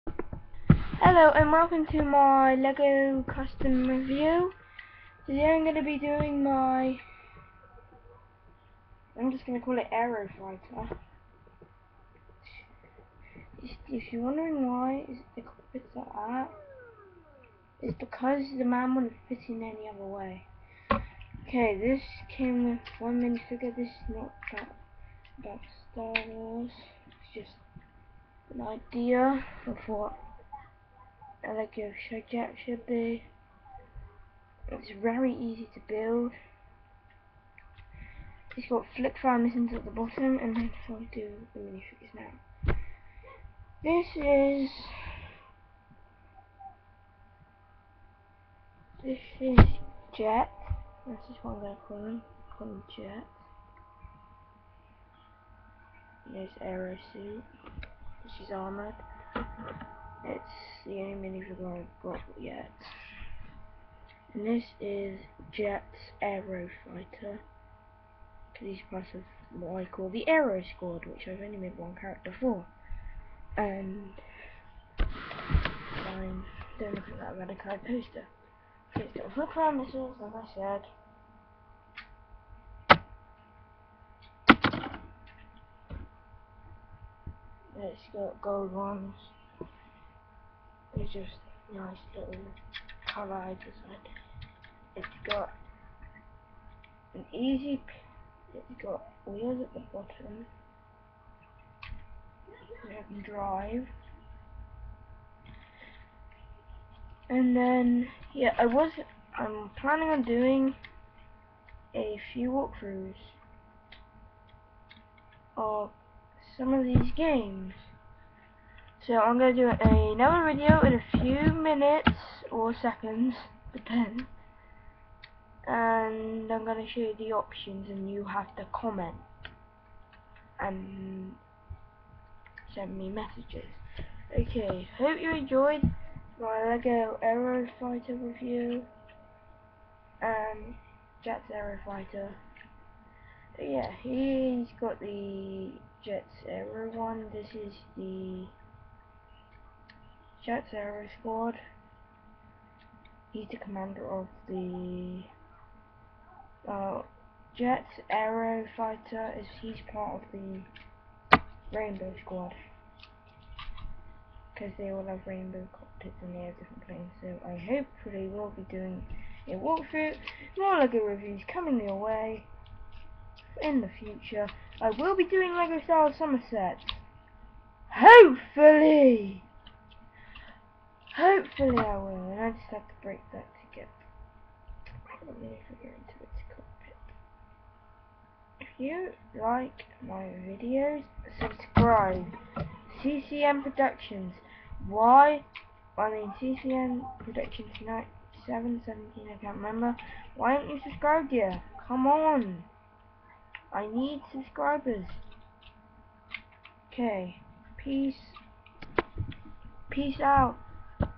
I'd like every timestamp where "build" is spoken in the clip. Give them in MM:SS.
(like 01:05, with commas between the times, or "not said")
00:35.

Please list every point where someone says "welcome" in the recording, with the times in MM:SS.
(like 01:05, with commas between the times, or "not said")
00:01.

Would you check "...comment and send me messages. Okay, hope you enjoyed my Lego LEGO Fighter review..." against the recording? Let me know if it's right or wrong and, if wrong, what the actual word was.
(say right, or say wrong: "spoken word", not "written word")
wrong: "Aero", not "LEGO".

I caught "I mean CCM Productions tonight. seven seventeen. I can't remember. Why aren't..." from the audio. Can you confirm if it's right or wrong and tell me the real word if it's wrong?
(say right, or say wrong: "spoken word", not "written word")
right.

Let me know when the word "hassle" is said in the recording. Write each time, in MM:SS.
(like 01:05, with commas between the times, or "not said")
not said.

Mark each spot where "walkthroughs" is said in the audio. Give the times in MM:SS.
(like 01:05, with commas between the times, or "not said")
01:52, 02:49.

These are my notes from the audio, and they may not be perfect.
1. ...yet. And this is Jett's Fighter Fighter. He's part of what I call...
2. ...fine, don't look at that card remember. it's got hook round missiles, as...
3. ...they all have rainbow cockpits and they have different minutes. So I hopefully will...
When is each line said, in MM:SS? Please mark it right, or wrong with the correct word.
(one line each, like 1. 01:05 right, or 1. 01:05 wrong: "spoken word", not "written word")
1. 01:02 wrong: "Aero", not "Fighter"
2. 01:14 wrong: "poster", not "remember"
3. 02:44 wrong: "planes", not "minutes".